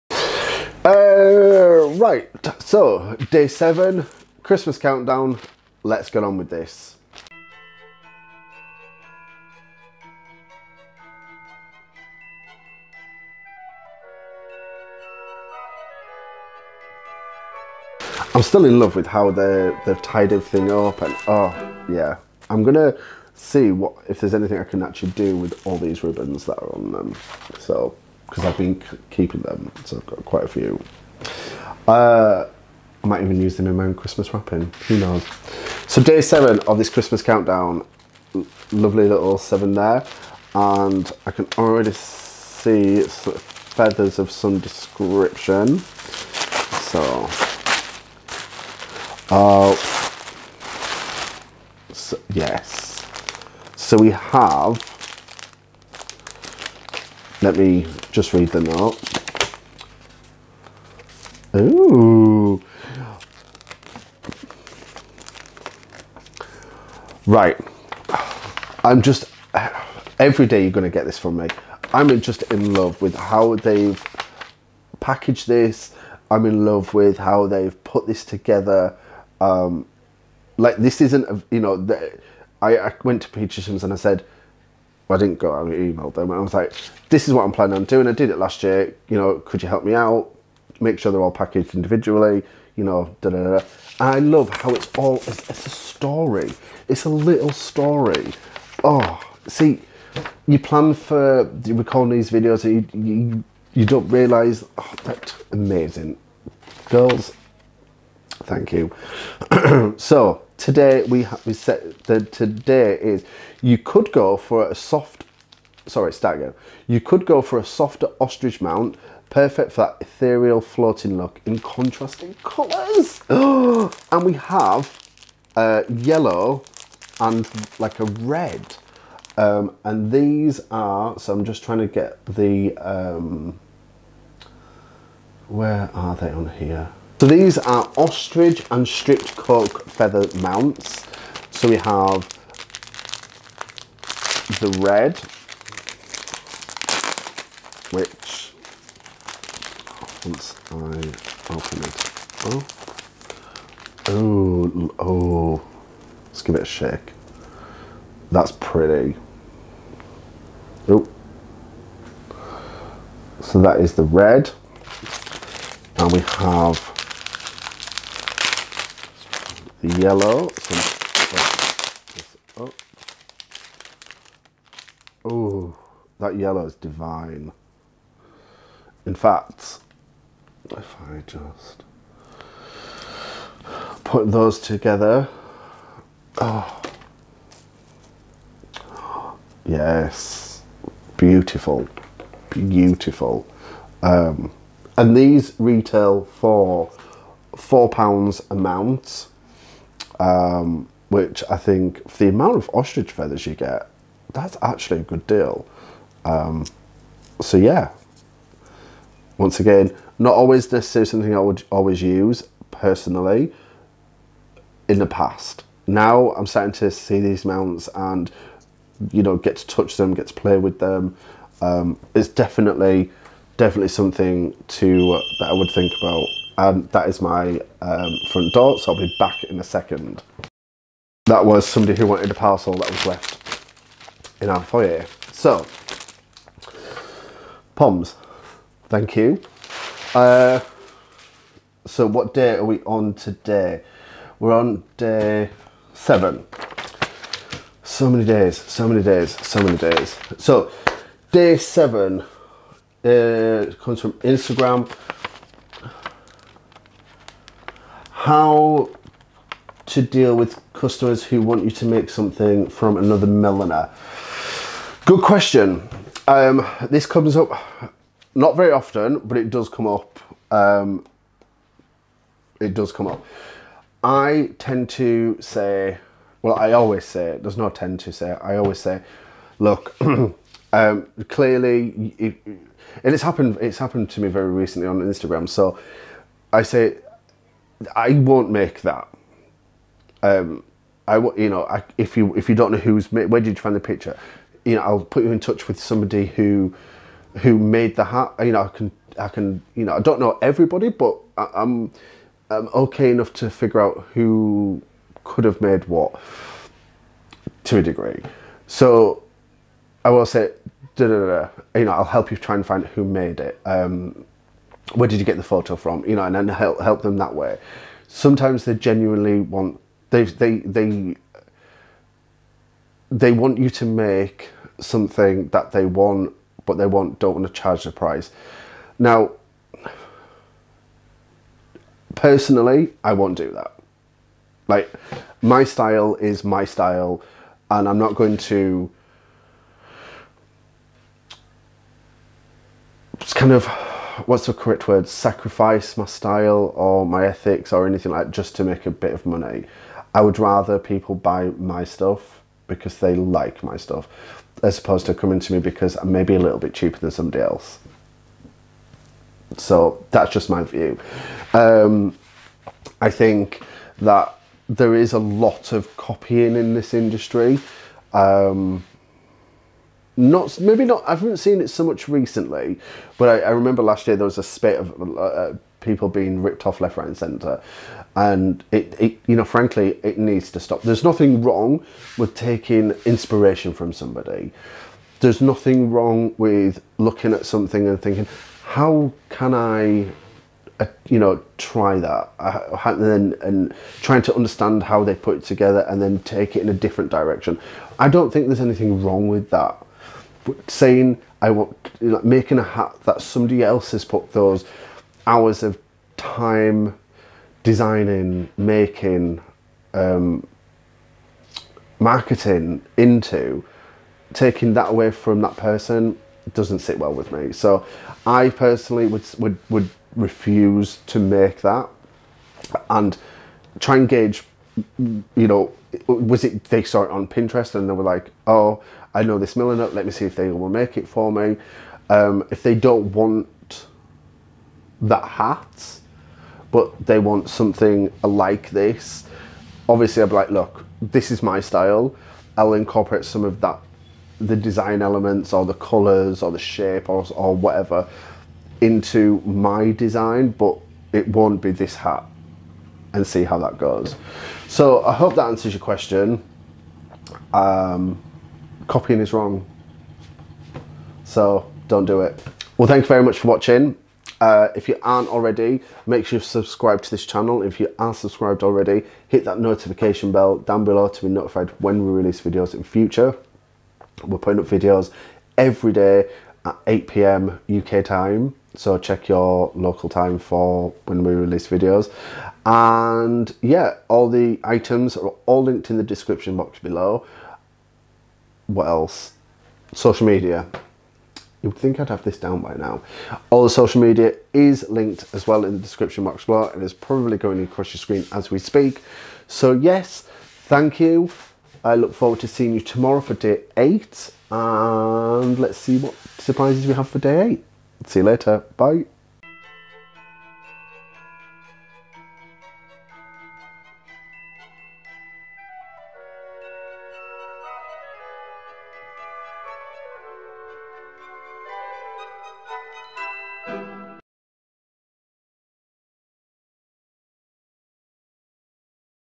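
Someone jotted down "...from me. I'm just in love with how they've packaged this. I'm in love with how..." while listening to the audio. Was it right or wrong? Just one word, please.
right.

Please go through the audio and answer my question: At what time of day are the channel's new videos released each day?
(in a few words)
8 p.m. UK time.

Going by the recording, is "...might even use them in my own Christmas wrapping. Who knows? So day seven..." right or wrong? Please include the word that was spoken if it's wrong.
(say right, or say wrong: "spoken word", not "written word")
right.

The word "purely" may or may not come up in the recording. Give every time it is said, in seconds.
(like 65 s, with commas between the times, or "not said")
not said.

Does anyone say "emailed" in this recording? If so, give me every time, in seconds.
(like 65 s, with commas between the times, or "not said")
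85 s.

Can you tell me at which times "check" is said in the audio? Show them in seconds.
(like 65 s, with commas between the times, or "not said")
478 s.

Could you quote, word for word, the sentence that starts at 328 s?
Now, personally, I won't do that.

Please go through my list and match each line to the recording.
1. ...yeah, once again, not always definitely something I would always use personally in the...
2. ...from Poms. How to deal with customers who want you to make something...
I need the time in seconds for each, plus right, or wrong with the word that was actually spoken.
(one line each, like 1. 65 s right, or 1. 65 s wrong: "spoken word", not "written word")
1. 207 s wrong: "necessarily", not "definitely"
2. 254 s wrong: "Instagram", not "Poms".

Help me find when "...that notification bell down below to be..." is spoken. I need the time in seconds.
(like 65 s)
469 s.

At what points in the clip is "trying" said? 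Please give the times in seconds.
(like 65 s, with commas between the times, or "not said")
131 s, 394 s.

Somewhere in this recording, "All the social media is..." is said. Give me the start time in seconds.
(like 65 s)
493 s.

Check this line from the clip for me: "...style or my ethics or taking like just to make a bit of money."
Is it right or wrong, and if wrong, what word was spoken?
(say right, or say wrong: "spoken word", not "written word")
wrong: "anything", not "taking".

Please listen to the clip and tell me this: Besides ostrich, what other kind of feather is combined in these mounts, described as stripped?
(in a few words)
Coque.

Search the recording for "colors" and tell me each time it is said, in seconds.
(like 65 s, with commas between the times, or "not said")
122 s, 445 s.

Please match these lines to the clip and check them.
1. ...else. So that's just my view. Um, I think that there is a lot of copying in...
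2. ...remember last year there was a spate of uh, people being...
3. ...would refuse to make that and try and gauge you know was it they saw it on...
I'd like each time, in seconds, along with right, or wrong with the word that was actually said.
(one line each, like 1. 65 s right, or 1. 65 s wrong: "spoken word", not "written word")
1. 357 s right
2. 373 s right
3. 419 s right.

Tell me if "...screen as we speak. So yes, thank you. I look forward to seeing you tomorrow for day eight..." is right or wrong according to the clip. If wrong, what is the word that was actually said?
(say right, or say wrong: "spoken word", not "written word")
right.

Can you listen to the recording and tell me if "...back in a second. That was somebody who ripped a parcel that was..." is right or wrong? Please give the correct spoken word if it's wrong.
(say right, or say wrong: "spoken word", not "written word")
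wrong: "wanted", not "ripped".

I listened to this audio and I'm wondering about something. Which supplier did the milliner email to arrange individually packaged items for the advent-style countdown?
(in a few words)
Petershams.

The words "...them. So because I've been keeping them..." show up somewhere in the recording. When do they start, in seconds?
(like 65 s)
26 s.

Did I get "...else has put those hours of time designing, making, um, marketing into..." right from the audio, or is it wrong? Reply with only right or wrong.
right.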